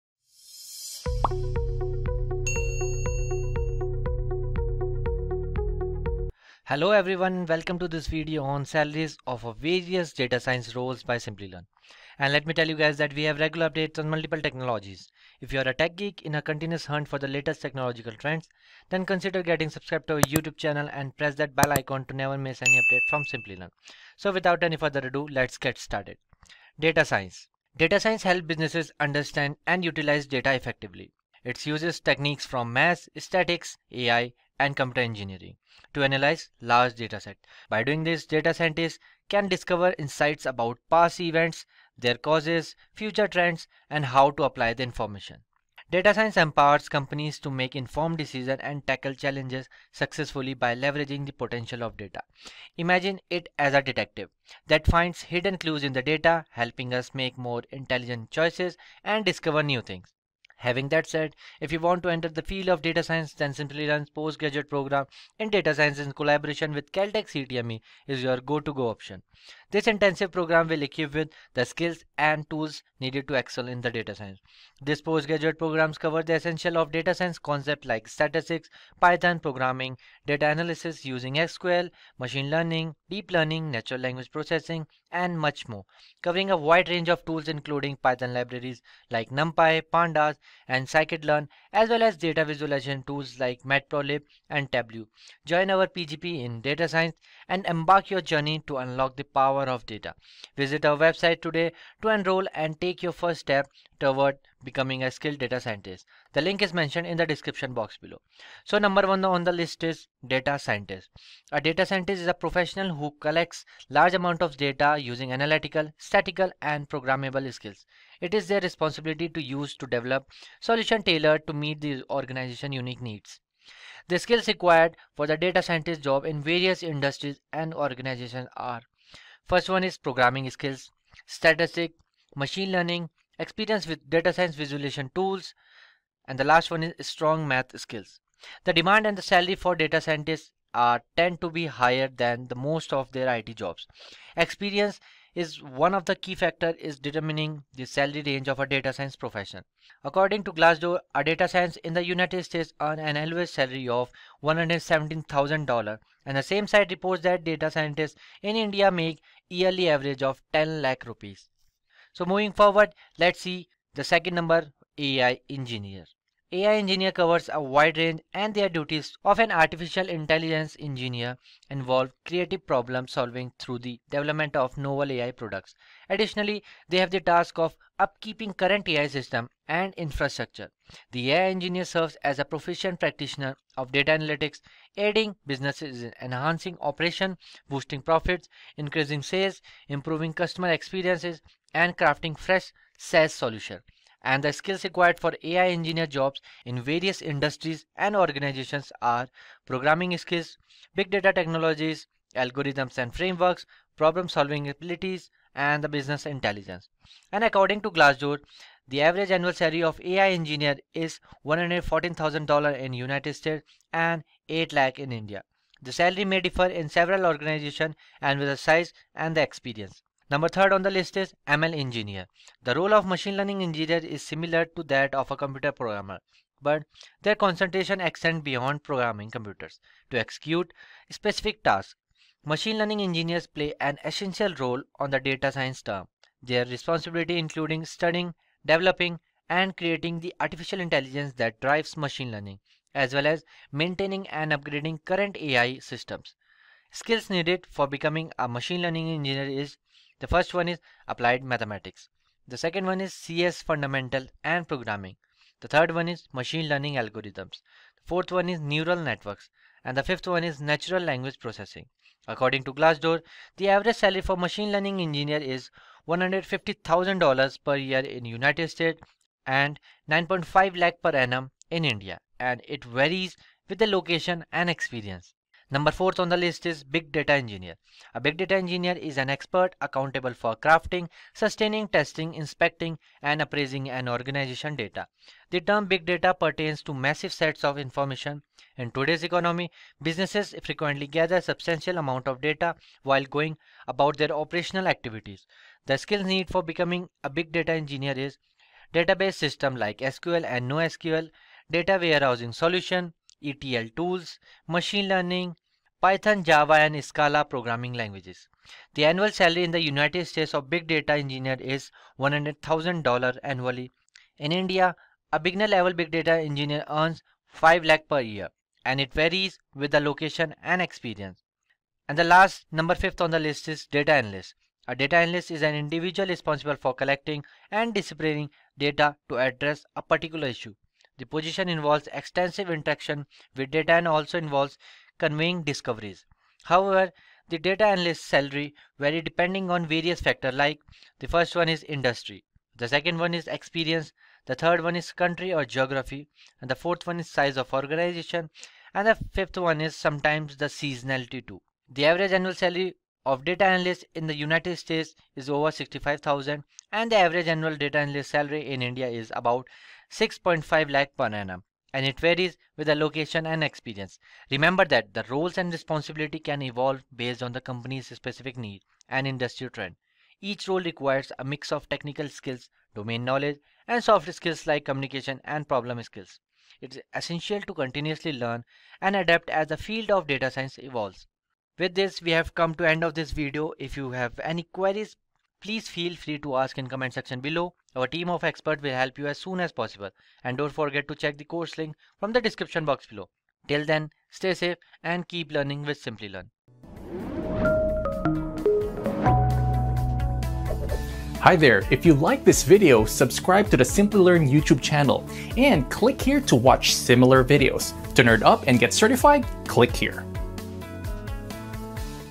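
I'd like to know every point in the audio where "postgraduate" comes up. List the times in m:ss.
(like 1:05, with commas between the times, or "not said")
1:04, 1:15.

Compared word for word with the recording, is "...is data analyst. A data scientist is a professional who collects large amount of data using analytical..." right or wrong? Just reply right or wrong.
wrong.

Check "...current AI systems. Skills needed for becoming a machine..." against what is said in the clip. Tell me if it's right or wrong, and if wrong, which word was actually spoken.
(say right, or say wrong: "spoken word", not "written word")
right.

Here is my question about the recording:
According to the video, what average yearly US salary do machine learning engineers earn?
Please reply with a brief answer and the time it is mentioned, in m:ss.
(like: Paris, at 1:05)
$150,000, at 4:26.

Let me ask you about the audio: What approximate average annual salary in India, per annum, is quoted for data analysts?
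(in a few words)
6.5 lakh.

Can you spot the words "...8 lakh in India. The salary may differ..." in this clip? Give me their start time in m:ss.
3:34.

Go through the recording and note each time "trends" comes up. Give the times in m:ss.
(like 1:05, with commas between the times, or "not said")
0:18, 0:43, 6:09.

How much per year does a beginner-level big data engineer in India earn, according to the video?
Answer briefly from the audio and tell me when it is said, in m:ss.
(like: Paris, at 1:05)
5 lakh, at 5:17.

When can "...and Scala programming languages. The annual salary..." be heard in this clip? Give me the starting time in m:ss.
5:06.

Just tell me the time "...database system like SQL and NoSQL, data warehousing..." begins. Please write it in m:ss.
4:58.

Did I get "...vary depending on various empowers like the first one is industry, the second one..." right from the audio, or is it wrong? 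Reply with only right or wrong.
wrong.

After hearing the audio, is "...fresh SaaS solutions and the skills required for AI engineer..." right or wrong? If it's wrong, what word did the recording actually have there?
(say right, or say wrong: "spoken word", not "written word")
right.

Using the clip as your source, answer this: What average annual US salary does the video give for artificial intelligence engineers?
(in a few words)
$114,000.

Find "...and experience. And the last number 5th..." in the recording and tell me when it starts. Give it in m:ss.
5:20.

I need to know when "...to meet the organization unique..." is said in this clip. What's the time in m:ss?
2:01.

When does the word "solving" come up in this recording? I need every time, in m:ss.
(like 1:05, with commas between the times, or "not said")
2:53, 3:24.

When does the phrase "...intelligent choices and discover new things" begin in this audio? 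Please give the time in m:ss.
0:57.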